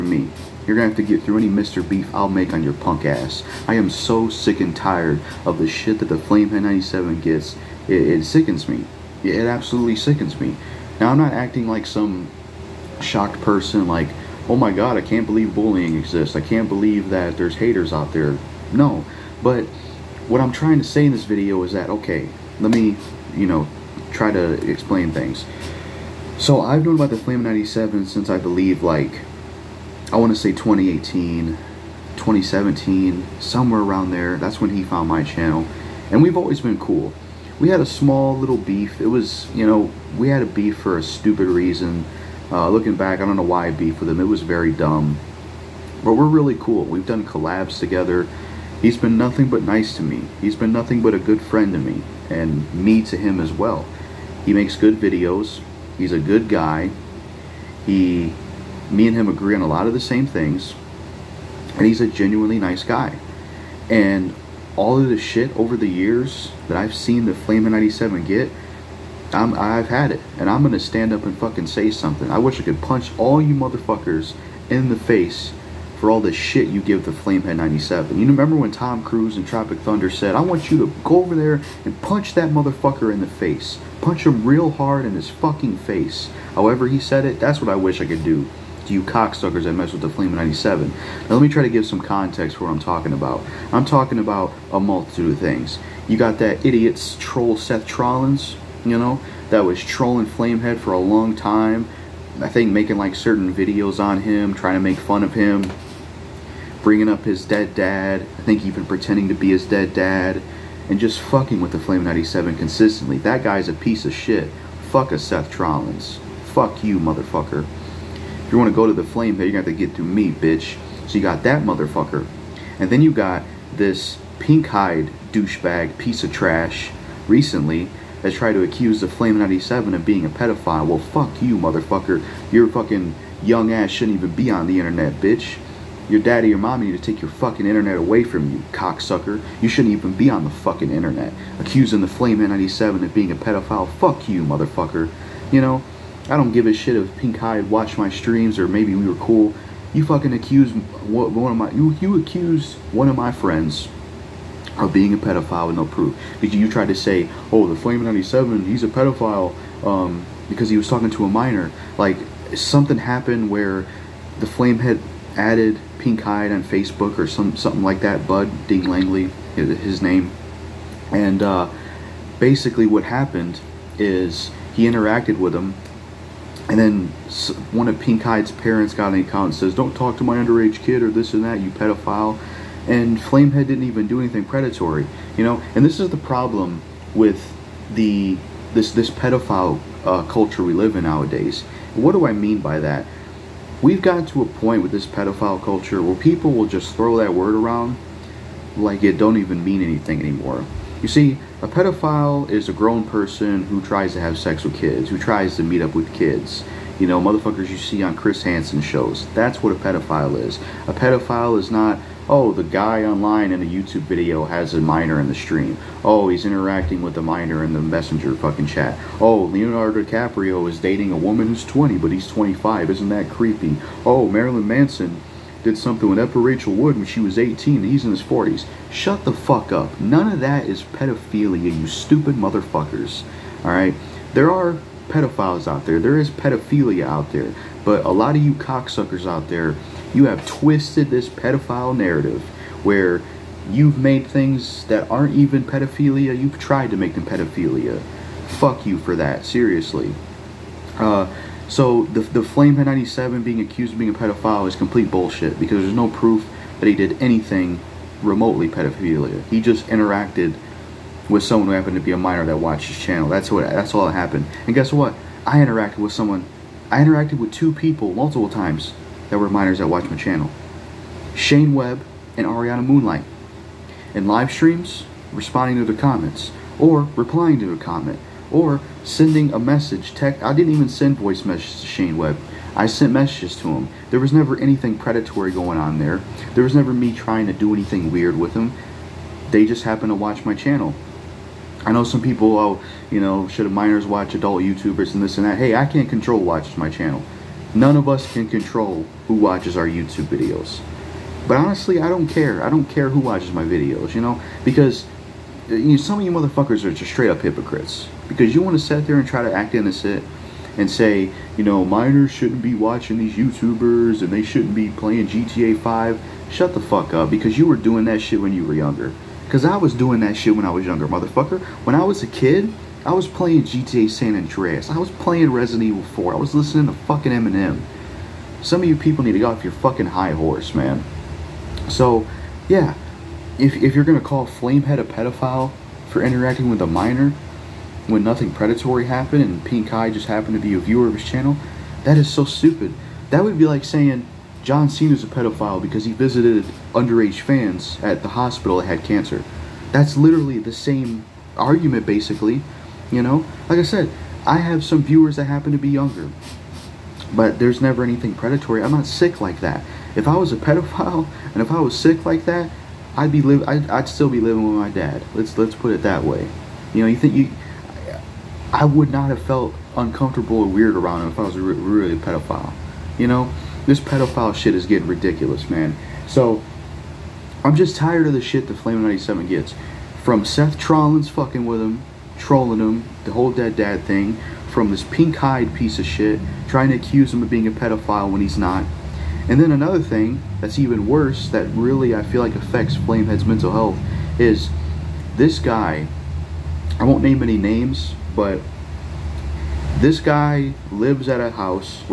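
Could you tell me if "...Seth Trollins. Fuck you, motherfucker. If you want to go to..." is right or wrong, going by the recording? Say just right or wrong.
right.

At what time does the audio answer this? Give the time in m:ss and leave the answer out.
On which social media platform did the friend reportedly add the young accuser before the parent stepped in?
2:46.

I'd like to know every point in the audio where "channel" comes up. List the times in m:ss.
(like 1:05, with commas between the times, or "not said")
0:35, 4:22, 4:30, 4:50, 4:56, 5:41.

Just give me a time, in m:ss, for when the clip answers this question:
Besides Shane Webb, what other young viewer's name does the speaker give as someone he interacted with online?
4:32.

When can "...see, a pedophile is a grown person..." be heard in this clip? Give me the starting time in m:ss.
3:21.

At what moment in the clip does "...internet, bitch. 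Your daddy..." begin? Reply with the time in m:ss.
2:14.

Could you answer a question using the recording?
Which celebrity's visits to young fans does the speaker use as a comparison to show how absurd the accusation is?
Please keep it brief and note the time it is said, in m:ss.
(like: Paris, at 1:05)
John Cena, at 5:44.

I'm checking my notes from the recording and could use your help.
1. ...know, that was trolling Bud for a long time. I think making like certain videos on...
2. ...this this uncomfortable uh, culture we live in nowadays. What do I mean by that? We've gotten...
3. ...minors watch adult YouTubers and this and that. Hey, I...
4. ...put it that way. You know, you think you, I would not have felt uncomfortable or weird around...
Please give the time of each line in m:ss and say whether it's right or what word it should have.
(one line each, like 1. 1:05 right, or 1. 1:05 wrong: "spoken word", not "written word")
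1. 1:38 wrong: "Flamehead", not "Bud"
2. 3:08 wrong: "pedophile", not "uncomfortable"
3. 4:53 right
4. 6:05 right.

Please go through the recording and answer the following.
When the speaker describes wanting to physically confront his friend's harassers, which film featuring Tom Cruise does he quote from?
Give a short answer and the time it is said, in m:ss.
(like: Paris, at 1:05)
Tropic Thunder, at 1:19.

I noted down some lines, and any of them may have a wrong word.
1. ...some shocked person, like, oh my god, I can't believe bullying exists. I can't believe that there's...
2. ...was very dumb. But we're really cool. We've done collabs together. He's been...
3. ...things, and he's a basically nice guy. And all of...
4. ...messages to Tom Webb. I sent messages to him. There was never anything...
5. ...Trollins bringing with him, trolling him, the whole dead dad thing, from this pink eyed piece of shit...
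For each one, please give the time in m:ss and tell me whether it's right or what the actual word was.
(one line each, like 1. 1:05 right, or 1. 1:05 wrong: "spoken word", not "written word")
1. 0:11 right
2. 0:44 right
3. 1:00 wrong: "genuinely", not "basically"
4. 4:41 wrong: "Shane", not "Tom"
5. 6:20 wrong: "fucking", not "bringing".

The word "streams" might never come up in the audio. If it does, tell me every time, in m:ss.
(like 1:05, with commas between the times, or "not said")
2:28, 3:35, 4:34.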